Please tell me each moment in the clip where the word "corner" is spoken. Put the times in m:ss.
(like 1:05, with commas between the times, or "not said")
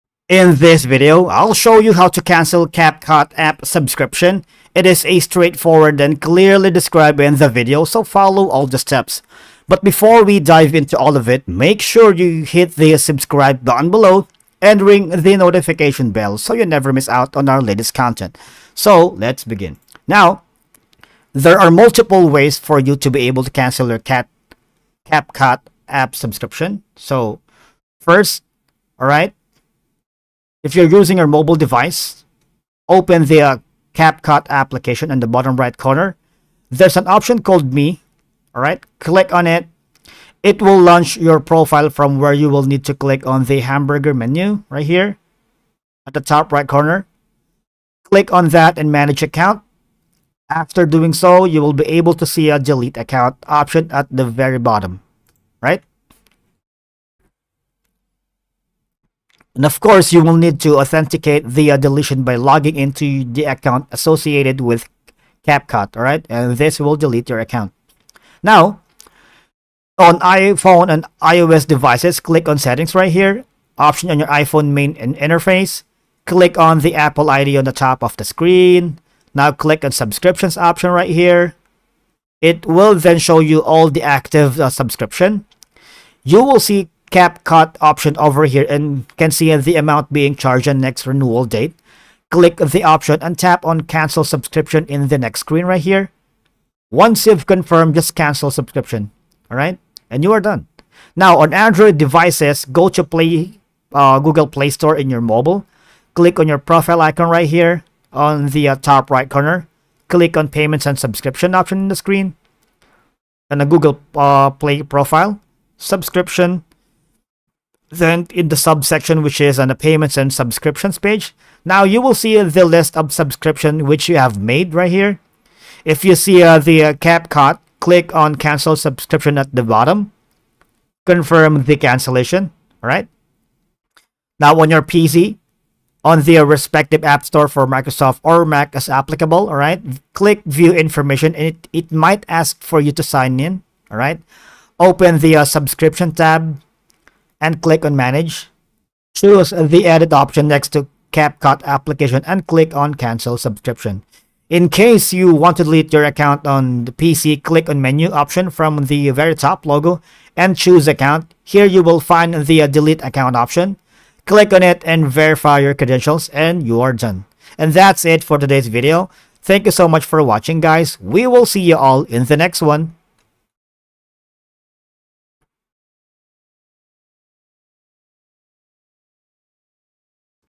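0:35, 0:46, 1:49.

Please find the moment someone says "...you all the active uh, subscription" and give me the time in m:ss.
1:23.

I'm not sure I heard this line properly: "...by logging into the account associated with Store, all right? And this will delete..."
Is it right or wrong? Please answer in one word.
wrong.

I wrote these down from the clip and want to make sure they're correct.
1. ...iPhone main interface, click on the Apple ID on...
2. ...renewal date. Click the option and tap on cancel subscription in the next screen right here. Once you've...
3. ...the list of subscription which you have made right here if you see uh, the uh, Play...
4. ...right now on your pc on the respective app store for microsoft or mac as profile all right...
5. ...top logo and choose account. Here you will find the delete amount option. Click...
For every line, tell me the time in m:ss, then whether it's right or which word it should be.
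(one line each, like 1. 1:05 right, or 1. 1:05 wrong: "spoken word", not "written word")
1. 1:14 right
2. 1:31 right
3. 2:02 wrong: "CapCut", not "Play"
4. 2:12 wrong: "applicable", not "profile"
5. 2:39 wrong: "account", not "amount".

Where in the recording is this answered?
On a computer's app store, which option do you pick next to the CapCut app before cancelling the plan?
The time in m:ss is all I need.
2:29.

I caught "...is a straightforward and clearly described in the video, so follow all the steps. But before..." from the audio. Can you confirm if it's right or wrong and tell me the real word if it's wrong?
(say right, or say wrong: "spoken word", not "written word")
right.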